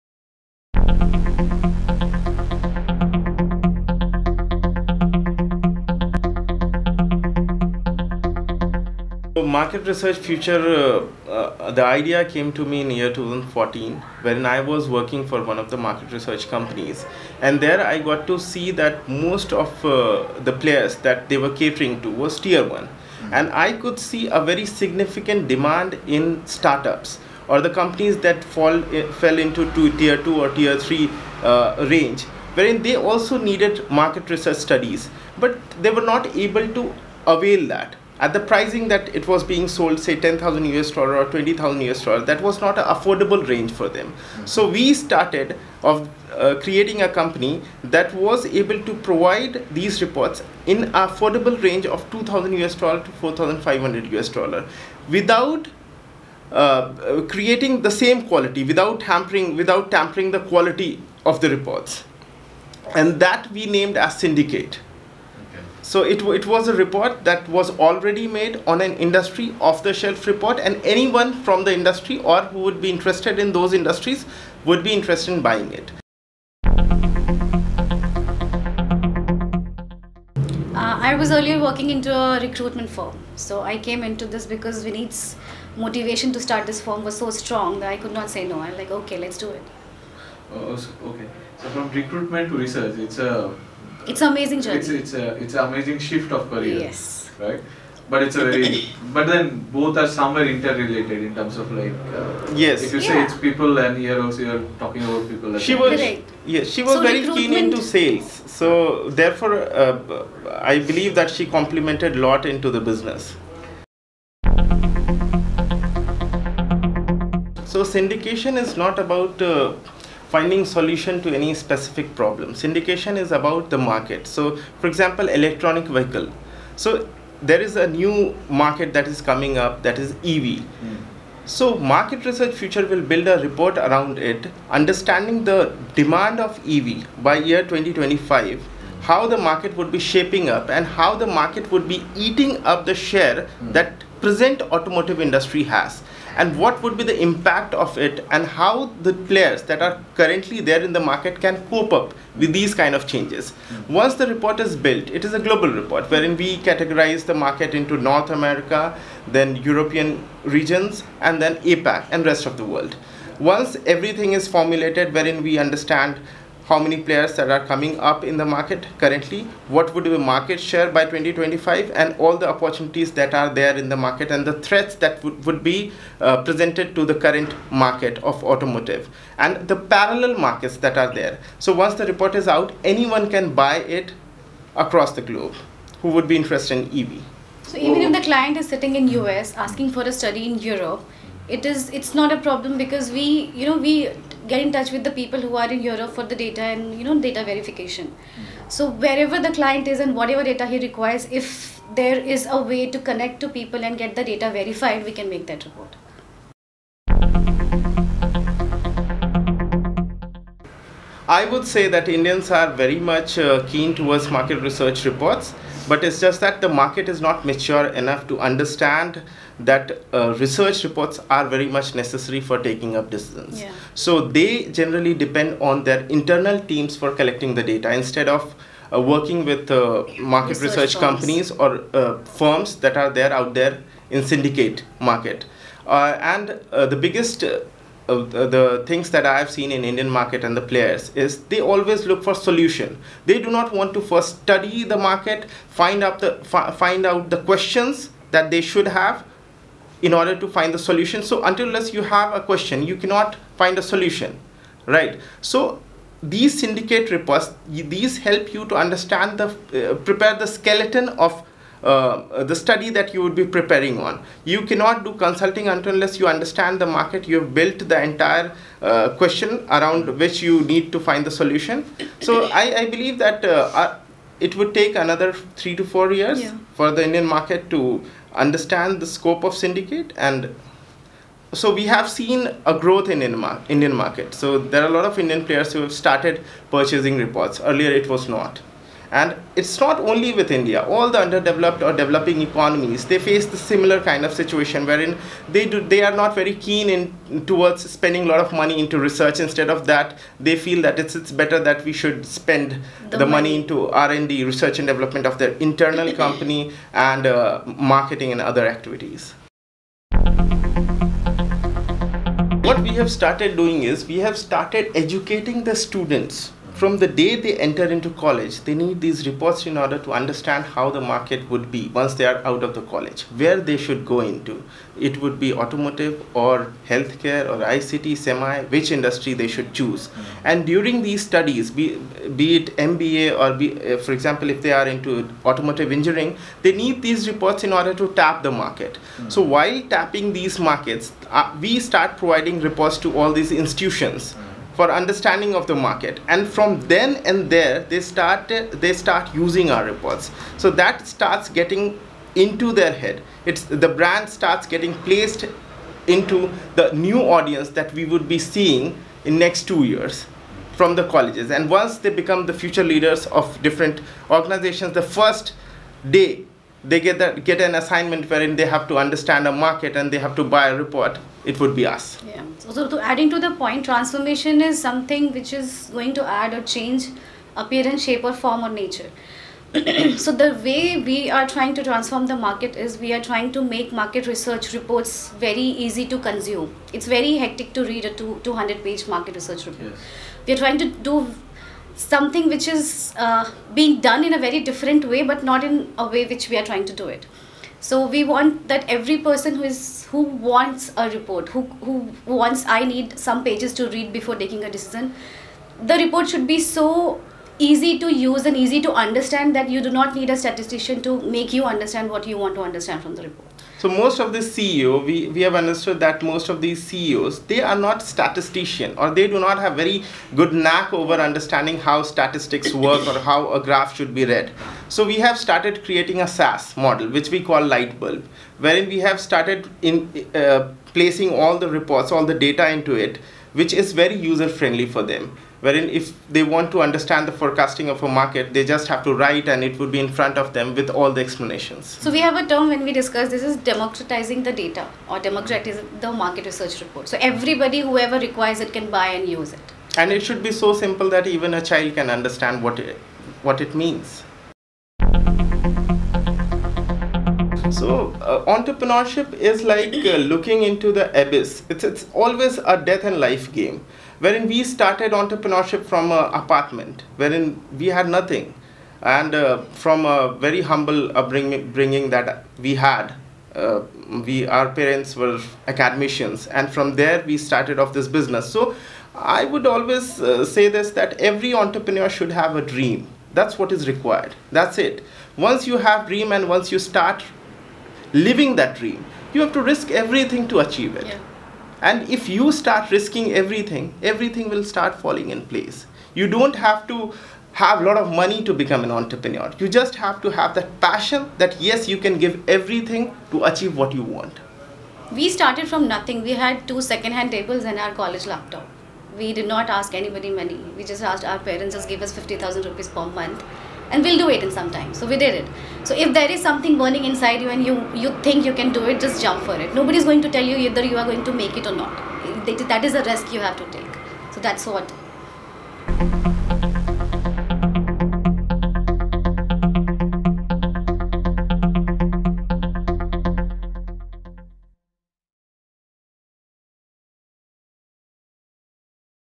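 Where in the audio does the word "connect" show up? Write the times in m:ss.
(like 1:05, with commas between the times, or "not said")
3:22.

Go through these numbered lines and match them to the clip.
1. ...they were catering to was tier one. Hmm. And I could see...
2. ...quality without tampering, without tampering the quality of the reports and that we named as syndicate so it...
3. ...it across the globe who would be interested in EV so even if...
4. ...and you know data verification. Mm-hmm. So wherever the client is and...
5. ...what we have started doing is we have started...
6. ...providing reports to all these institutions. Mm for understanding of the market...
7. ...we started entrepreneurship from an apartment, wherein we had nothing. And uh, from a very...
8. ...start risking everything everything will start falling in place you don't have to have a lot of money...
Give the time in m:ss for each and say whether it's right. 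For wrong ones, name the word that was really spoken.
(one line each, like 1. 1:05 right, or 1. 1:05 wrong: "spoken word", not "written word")
1. 0:21 right
2. 0:58 right
3. 3:03 right
4. 3:16 right
5. 5:12 right
6. 5:42 right
7. 7:44 right
8. 8:12 right.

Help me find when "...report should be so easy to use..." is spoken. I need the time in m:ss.
6:45.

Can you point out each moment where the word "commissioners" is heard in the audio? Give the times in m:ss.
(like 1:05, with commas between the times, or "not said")
not said.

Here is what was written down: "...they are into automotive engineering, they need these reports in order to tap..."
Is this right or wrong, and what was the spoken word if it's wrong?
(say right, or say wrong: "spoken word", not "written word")
right.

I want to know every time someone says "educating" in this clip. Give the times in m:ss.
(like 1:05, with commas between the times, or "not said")
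5:14.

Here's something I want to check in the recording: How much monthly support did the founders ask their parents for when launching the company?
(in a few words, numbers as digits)
50,000 rupees.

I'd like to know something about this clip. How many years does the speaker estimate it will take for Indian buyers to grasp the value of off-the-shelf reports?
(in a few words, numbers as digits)
3 to 4 years.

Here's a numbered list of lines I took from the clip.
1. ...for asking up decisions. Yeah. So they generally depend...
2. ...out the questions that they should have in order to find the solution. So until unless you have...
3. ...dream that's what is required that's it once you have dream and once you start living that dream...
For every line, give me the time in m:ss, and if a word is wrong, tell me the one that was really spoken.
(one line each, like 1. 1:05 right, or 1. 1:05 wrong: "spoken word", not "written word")
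1. 3:42 wrong: "taking", not "asking"
2. 4:07 right
3. 8:02 right.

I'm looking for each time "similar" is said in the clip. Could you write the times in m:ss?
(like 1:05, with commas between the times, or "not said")
4:53.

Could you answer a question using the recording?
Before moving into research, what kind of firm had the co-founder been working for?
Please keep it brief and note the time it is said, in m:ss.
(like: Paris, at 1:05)
A recruitment firm, at 1:22.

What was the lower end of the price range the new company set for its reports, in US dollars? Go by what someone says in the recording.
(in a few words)
$2,000.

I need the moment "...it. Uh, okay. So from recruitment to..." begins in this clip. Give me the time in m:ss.
1:29.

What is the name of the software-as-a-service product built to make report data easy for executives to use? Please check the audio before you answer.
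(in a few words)
Lightbulb.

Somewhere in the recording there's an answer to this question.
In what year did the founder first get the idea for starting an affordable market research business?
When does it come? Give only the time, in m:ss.
0:13.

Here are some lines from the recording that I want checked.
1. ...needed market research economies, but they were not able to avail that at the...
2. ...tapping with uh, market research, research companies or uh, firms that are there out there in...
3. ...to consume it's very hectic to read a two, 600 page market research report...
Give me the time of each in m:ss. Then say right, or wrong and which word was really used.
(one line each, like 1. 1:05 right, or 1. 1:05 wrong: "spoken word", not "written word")
1. 0:33 wrong: "studies", not "economies"
2. 3:49 wrong: "working", not "tapping"
3. 6:26 wrong: "200", not "600".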